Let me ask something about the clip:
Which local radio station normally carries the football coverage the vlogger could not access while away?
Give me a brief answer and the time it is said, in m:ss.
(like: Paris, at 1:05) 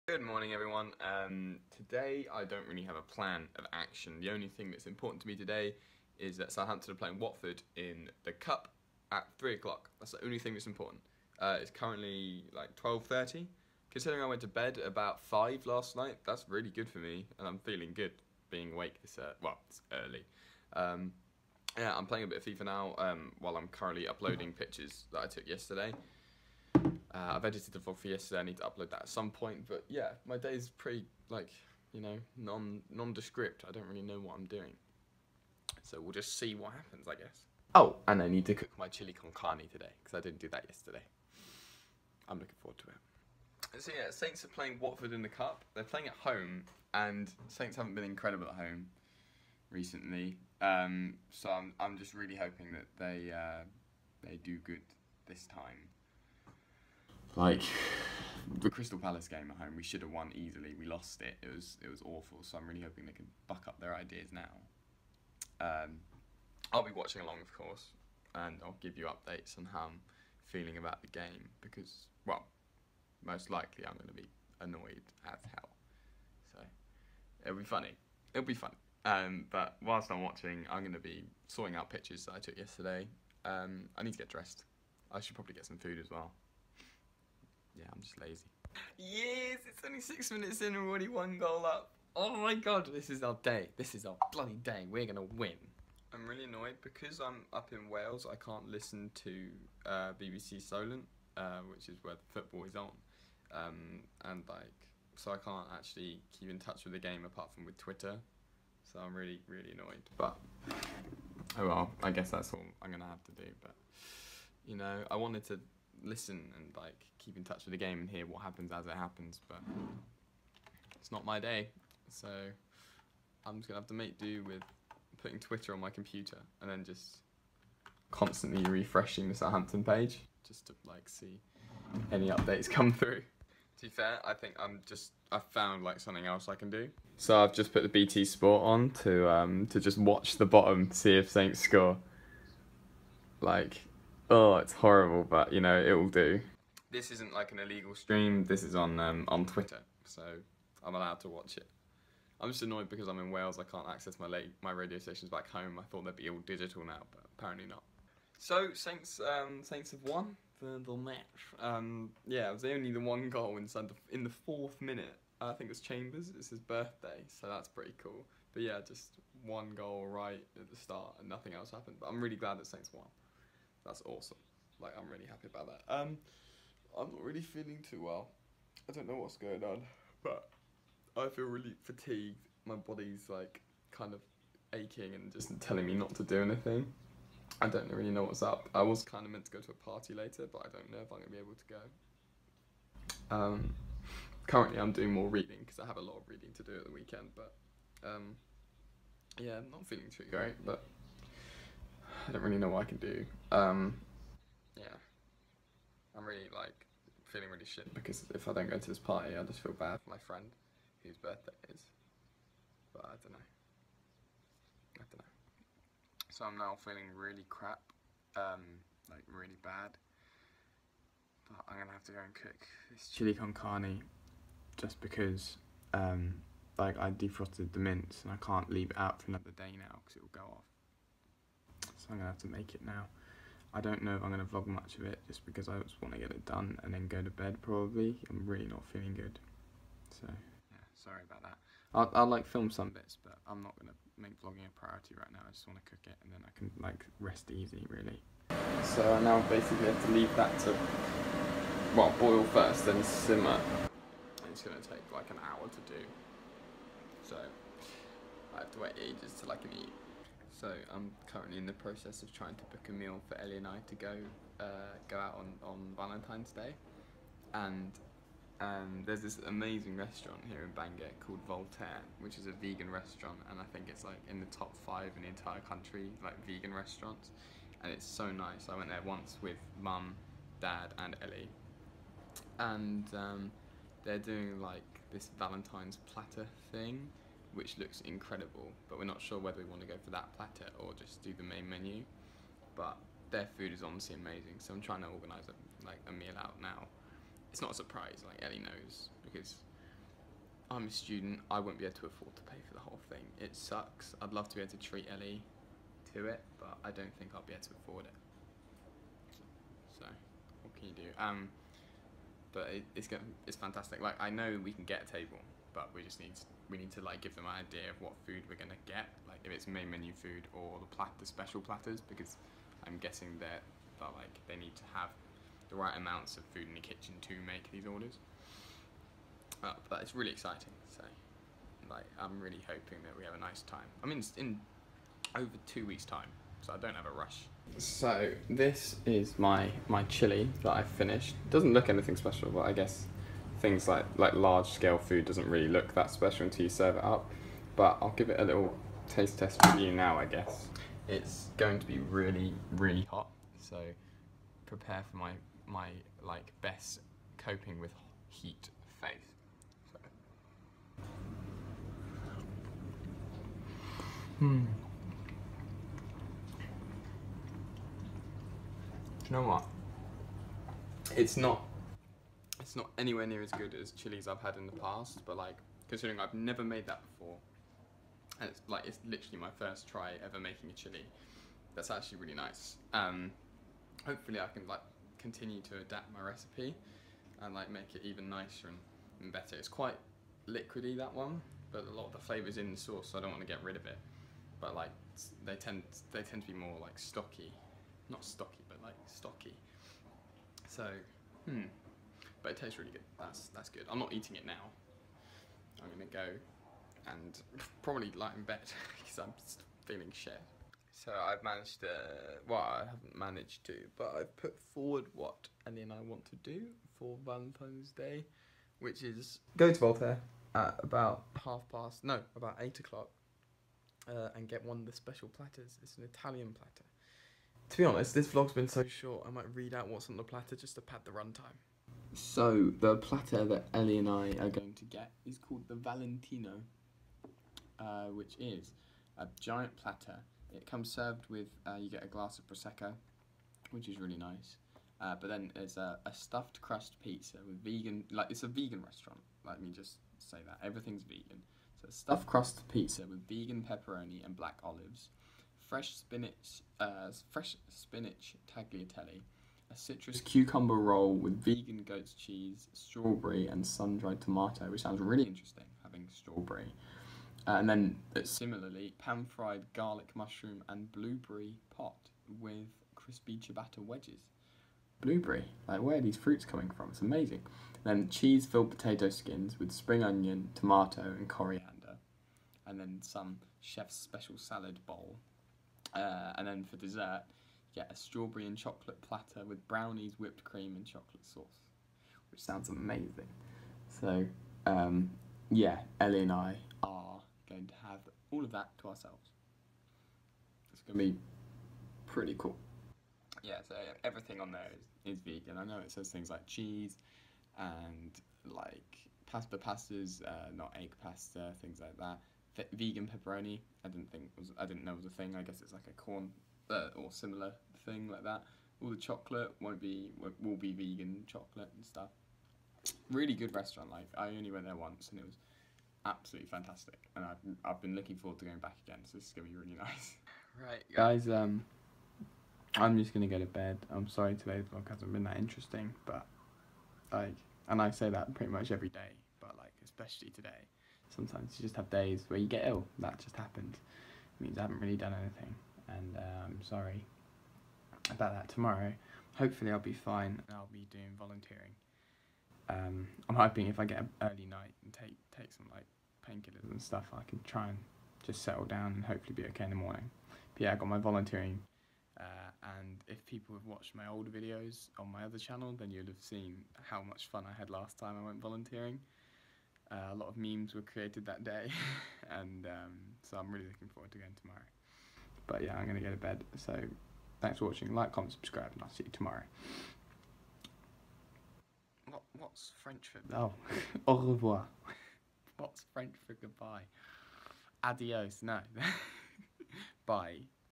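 BBC Solent, at 1:40.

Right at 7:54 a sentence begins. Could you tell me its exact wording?
Blueberry, like where are these fruits coming from?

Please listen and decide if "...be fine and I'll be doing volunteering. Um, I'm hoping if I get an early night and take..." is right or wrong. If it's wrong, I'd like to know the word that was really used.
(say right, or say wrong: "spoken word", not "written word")
right.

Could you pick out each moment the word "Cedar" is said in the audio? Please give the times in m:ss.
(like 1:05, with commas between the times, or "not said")
not said.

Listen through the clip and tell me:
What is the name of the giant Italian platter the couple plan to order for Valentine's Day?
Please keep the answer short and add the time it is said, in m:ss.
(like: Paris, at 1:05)
Valentino, at 7:15.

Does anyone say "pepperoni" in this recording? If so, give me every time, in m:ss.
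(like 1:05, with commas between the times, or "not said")
7:33, 8:33.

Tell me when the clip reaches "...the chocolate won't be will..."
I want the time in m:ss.
8:38.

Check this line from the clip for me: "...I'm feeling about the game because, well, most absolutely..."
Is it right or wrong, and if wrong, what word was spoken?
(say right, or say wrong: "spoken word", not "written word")
wrong: "likely", not "absolutely".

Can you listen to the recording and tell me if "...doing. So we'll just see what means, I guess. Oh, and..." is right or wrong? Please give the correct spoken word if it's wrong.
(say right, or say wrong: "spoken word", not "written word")
wrong: "happens", not "means".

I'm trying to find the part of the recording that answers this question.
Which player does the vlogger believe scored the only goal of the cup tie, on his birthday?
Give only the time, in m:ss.
2:45.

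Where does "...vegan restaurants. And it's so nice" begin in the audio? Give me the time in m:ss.
4:36.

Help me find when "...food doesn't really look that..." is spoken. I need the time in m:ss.
5:44.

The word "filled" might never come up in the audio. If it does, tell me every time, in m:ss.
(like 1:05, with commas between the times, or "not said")
7:58.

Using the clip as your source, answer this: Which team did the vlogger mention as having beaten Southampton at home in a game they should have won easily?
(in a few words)
Crystal Palace.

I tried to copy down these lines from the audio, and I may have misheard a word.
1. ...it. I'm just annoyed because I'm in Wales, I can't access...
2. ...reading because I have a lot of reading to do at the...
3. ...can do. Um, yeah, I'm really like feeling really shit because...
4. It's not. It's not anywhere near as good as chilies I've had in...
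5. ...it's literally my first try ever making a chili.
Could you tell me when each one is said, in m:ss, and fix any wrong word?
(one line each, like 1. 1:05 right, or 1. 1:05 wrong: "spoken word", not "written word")
1. 2:31 right
2. 3:15 right
3. 3:22 right
4. 6:11 right
5. 6:18 right.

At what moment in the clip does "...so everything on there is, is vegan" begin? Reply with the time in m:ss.
8:23.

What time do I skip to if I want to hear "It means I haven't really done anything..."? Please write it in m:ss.
9:04.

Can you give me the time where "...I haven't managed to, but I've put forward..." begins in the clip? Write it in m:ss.
6:52.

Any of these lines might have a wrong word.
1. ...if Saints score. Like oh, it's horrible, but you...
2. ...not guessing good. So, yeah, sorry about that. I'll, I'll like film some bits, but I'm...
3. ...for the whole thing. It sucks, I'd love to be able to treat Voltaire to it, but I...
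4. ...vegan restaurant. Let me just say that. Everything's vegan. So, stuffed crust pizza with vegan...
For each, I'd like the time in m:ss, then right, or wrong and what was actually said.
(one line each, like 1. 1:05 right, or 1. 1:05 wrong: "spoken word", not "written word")
1. 2:21 right
2. 3:58 wrong: "feeling", not "guessing"
3. 5:02 wrong: "Ellie", not "Voltaire"
4. 7:28 right.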